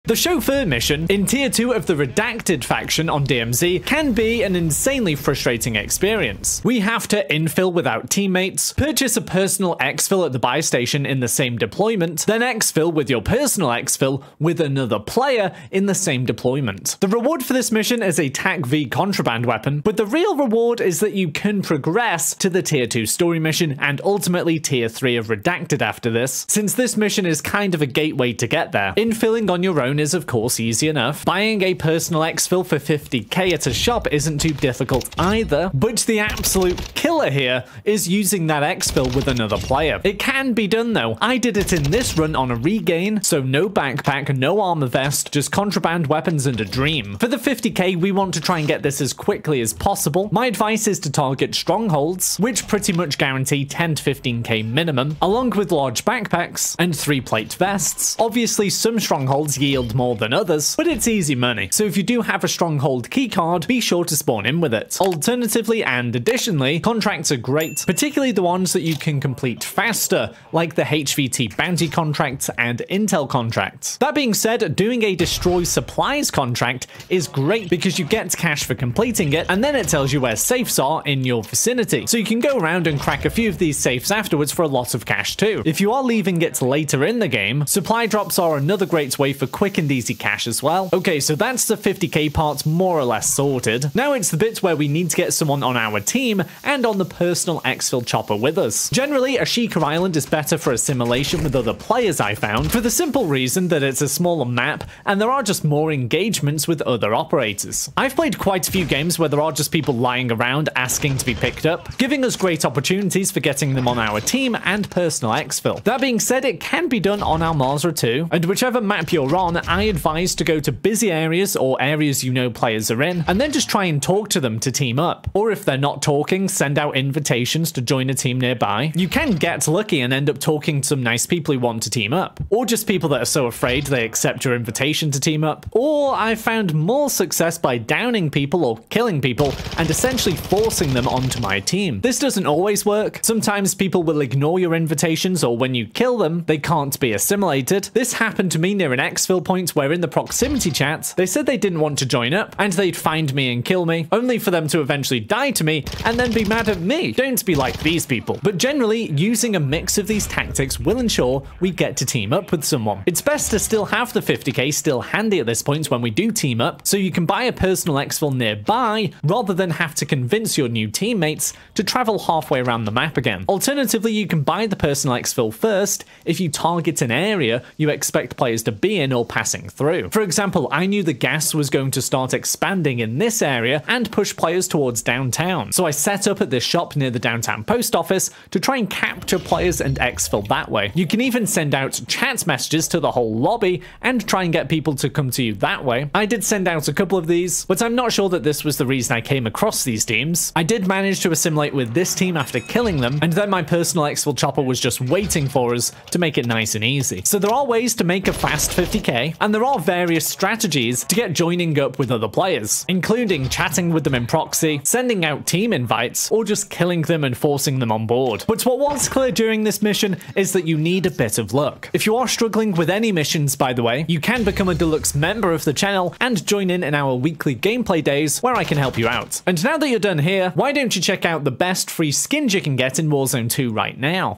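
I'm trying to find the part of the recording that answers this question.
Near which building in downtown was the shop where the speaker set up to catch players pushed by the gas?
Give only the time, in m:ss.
3:07.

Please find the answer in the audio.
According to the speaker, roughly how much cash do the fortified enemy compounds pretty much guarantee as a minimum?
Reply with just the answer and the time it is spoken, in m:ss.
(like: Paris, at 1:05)
10 to 15k, at 0:53.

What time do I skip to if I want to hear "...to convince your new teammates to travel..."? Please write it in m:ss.
2:49.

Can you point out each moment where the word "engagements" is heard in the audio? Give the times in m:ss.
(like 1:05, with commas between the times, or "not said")
1:45.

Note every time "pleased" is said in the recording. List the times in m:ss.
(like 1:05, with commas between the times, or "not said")
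not said.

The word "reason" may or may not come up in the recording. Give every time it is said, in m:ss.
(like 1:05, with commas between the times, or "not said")
1:43, 3:18.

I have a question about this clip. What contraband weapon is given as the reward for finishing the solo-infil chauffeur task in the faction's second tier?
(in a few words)
TAQ-V.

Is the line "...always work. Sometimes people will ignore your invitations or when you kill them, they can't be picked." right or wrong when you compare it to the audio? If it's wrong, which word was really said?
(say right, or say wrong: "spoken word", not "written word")
wrong: "assimilated", not "picked".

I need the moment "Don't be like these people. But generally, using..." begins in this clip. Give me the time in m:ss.
2:37.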